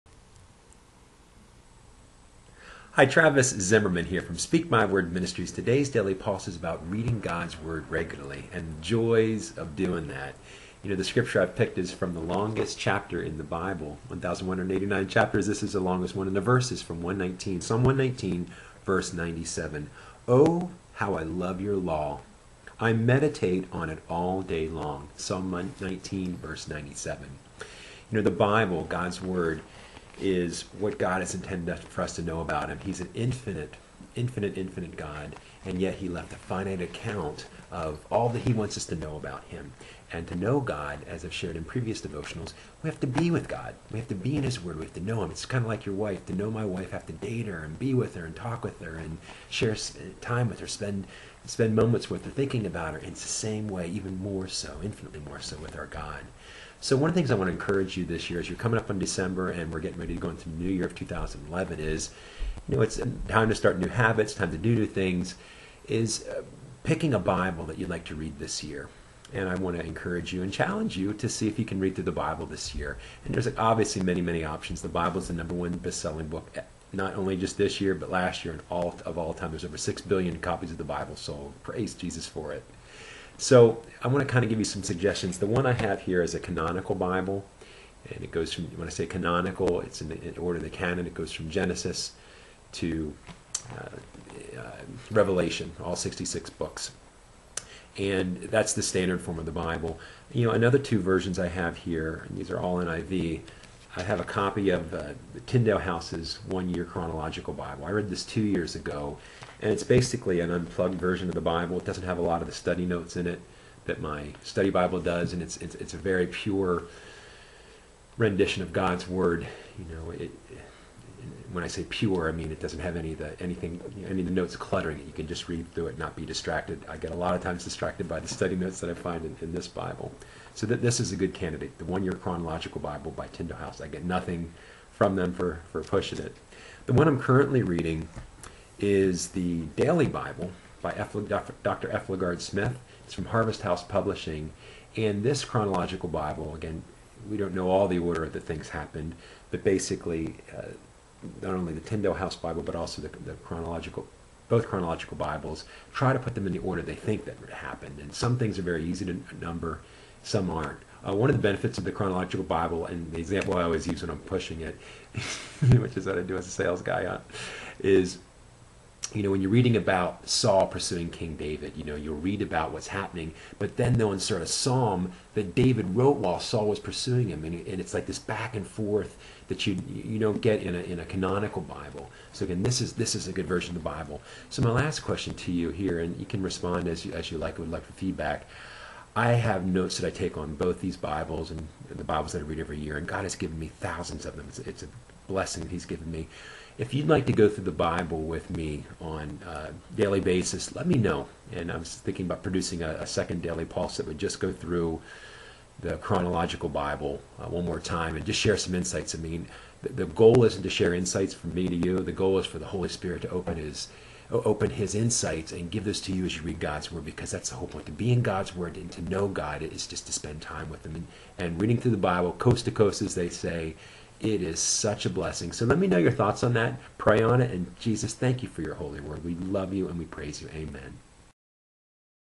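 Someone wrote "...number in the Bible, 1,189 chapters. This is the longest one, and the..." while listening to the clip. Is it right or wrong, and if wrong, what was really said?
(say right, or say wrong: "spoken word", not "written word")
wrong: "chapter", not "number".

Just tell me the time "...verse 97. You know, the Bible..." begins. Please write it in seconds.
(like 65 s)
26 s.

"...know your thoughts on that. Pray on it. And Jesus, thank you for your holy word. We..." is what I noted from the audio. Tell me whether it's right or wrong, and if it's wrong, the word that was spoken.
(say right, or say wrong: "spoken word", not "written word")
right.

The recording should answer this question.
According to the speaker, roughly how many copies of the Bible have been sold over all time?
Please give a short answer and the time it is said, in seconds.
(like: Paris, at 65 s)
over 6 billion, at 79 s.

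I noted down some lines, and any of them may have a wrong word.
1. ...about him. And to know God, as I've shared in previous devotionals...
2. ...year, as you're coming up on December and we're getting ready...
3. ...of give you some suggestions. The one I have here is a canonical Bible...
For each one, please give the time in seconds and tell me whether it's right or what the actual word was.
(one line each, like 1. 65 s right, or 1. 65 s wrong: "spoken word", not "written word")
1. 39 s right
2. 58 s right
3. 84 s right.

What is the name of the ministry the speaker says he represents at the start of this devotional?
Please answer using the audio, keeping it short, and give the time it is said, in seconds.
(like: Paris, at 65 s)
Speak My Word Ministries, at 4 s.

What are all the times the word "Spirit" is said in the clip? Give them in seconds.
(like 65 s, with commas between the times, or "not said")
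212 s.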